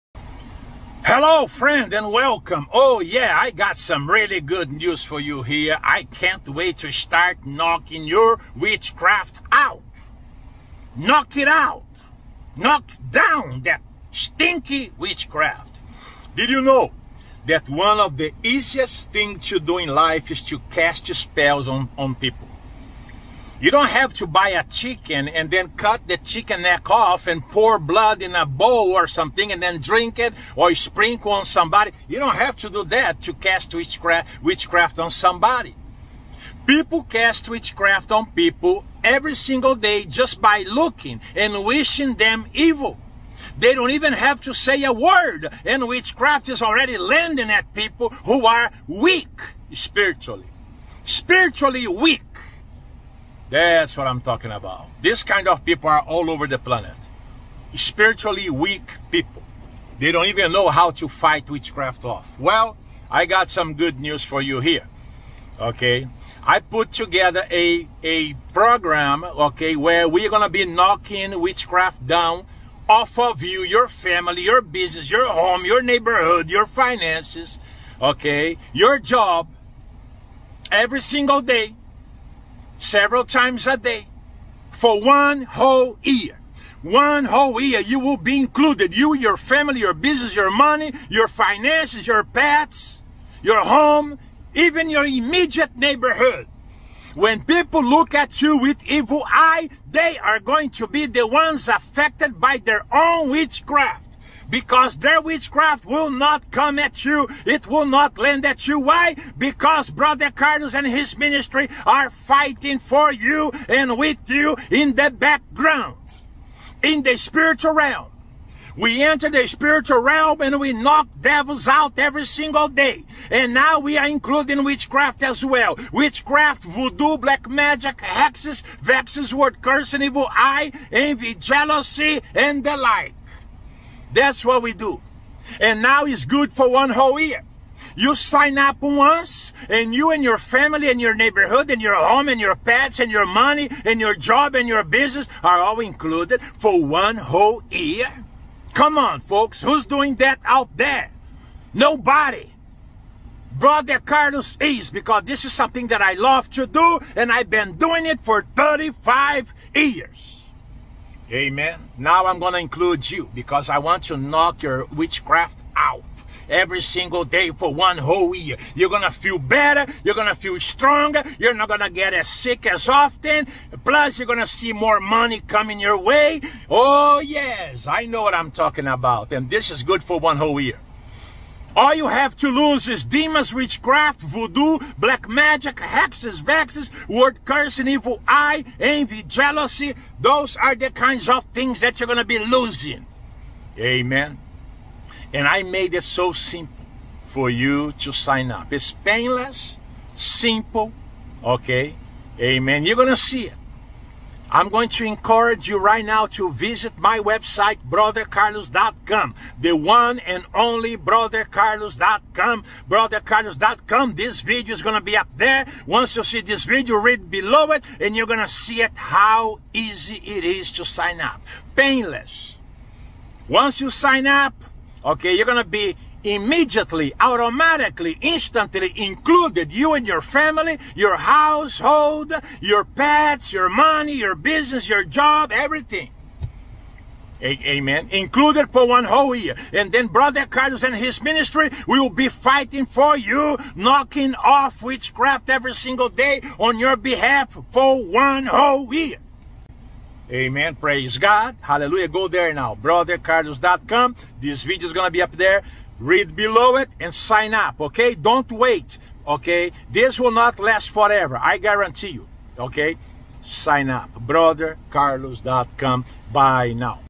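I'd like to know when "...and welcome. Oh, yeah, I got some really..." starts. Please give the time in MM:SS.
00:01.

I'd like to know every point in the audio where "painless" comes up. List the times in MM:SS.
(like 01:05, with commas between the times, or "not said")
03:18, 03:41.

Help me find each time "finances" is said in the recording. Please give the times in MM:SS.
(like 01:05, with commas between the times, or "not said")
01:16, 01:31.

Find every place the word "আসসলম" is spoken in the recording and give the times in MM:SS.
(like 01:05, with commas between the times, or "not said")
not said.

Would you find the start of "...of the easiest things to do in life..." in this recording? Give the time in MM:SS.
00:17.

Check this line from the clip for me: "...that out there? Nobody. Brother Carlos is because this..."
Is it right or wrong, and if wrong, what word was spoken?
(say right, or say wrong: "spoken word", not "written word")
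right.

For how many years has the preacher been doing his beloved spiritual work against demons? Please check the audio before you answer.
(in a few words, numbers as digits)
35.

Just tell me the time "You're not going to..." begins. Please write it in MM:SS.
02:51.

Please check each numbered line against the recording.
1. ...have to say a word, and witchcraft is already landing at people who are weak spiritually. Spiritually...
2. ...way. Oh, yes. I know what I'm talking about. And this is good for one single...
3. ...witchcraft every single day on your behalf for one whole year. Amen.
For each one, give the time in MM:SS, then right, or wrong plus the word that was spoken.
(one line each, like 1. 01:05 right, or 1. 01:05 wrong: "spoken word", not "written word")
1. 00:44 right
2. 02:55 wrong: "whole", not "single"
3. 04:04 right.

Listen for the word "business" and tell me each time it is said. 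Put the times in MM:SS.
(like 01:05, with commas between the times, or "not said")
01:14, 01:29, 02:24, 03:54.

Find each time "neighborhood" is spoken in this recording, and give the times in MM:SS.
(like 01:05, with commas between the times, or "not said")
01:15, 01:35, 02:21.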